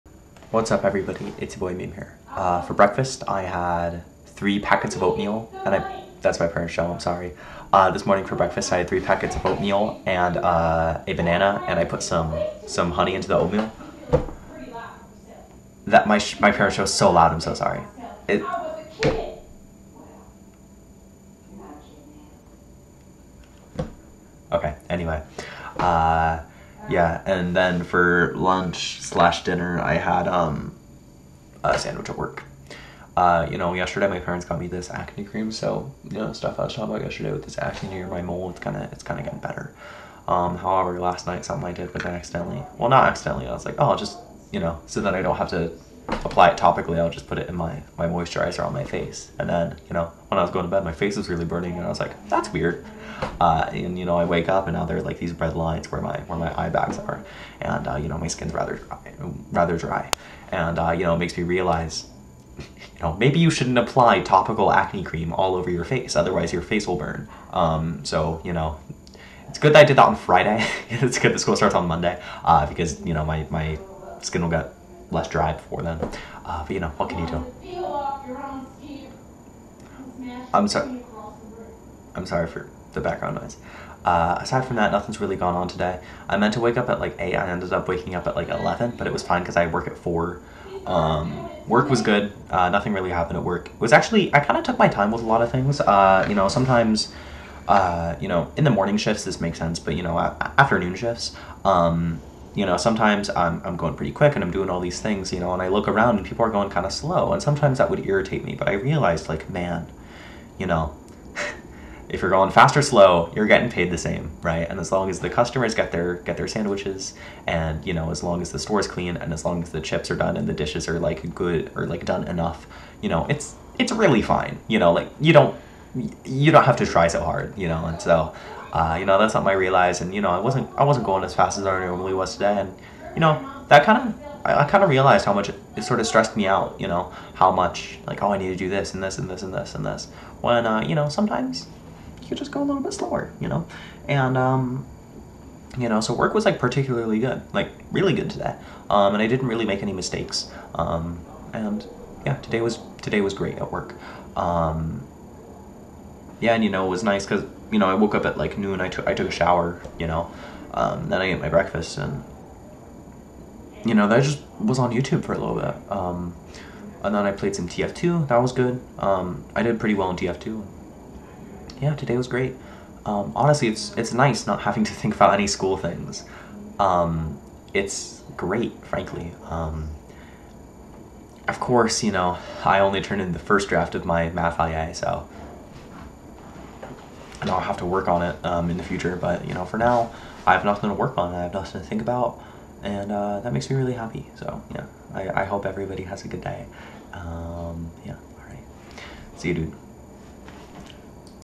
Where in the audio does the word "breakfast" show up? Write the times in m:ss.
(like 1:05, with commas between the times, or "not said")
0:02, 0:08, 2:41.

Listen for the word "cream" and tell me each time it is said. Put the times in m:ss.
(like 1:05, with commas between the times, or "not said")
0:35, 1:05.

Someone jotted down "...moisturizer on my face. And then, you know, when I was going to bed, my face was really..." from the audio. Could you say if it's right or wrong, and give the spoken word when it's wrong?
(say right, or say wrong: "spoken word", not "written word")
right.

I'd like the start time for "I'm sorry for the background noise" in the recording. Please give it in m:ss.
1:22.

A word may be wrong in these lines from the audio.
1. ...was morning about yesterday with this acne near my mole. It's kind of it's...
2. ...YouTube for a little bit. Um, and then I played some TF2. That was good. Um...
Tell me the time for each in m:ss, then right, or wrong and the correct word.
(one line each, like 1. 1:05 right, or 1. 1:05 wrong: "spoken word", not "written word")
1. 0:36 wrong: "talking", not "morning"
2. 2:44 right.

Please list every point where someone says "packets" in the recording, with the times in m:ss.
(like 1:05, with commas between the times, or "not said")
0:04, 0:08.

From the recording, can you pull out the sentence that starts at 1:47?
And sometimes that would irritate me.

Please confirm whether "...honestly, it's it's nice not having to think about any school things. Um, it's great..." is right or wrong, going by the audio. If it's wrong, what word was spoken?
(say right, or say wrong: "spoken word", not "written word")
right.